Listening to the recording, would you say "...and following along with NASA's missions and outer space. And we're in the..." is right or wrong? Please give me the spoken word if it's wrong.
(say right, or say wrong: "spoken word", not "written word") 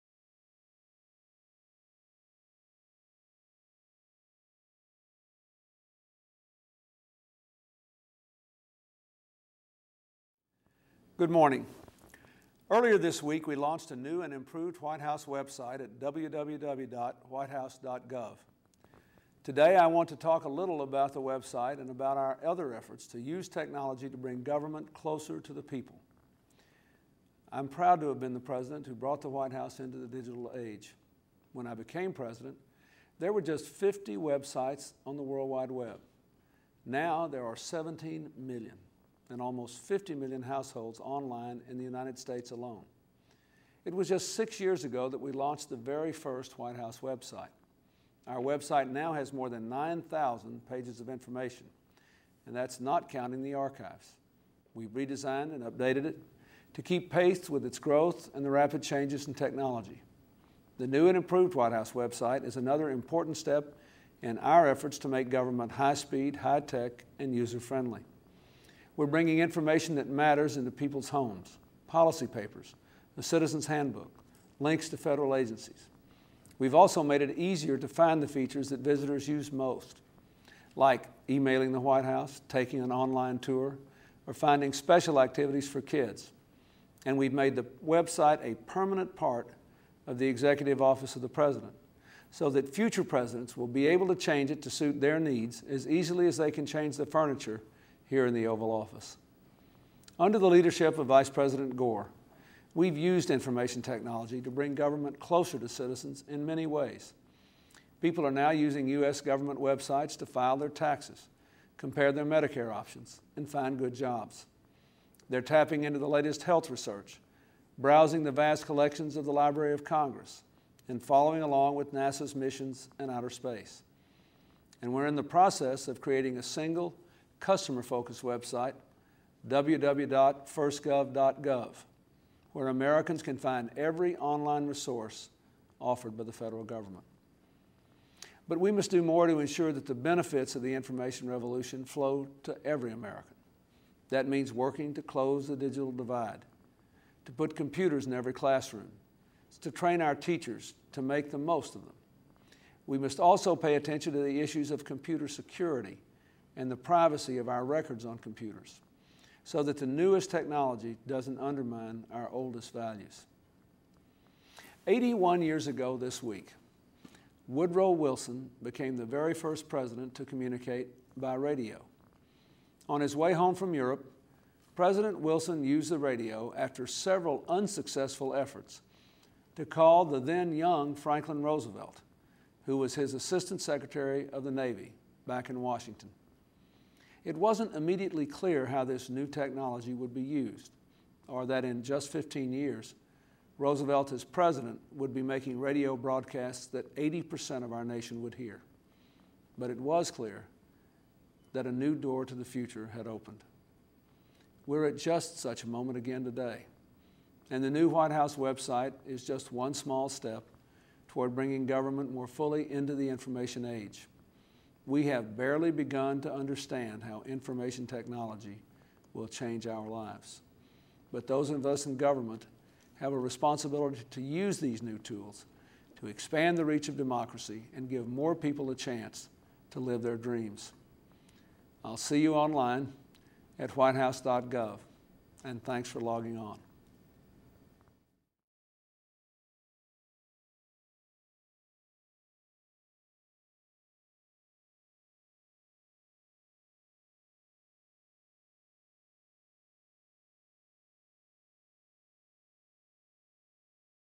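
right.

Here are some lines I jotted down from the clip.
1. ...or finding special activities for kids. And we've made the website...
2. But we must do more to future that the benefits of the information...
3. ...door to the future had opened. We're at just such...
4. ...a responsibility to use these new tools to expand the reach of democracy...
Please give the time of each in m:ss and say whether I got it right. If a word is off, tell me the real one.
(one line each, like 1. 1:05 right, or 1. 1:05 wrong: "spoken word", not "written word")
1. 1:24 right
2. 2:18 wrong: "ensure", not "future"
3. 3:21 right
4. 3:43 right.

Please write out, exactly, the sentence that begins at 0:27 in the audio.
I'm proud to have been the president who brought the White House into the digital age.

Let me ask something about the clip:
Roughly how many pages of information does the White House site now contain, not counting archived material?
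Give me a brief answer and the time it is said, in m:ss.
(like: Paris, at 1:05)
9,000, at 0:49.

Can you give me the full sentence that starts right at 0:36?
Now there are 17 million and almost 50 million households online in the United States alone.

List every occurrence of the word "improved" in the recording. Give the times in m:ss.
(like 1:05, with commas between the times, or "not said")
0:14, 1:01.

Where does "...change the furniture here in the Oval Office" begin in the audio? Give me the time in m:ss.
1:36.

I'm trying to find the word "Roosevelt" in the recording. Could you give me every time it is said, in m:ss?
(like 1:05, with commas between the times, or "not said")
3:01, 3:13.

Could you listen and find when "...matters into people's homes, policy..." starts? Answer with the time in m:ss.
1:10.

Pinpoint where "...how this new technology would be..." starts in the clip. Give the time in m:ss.
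3:08.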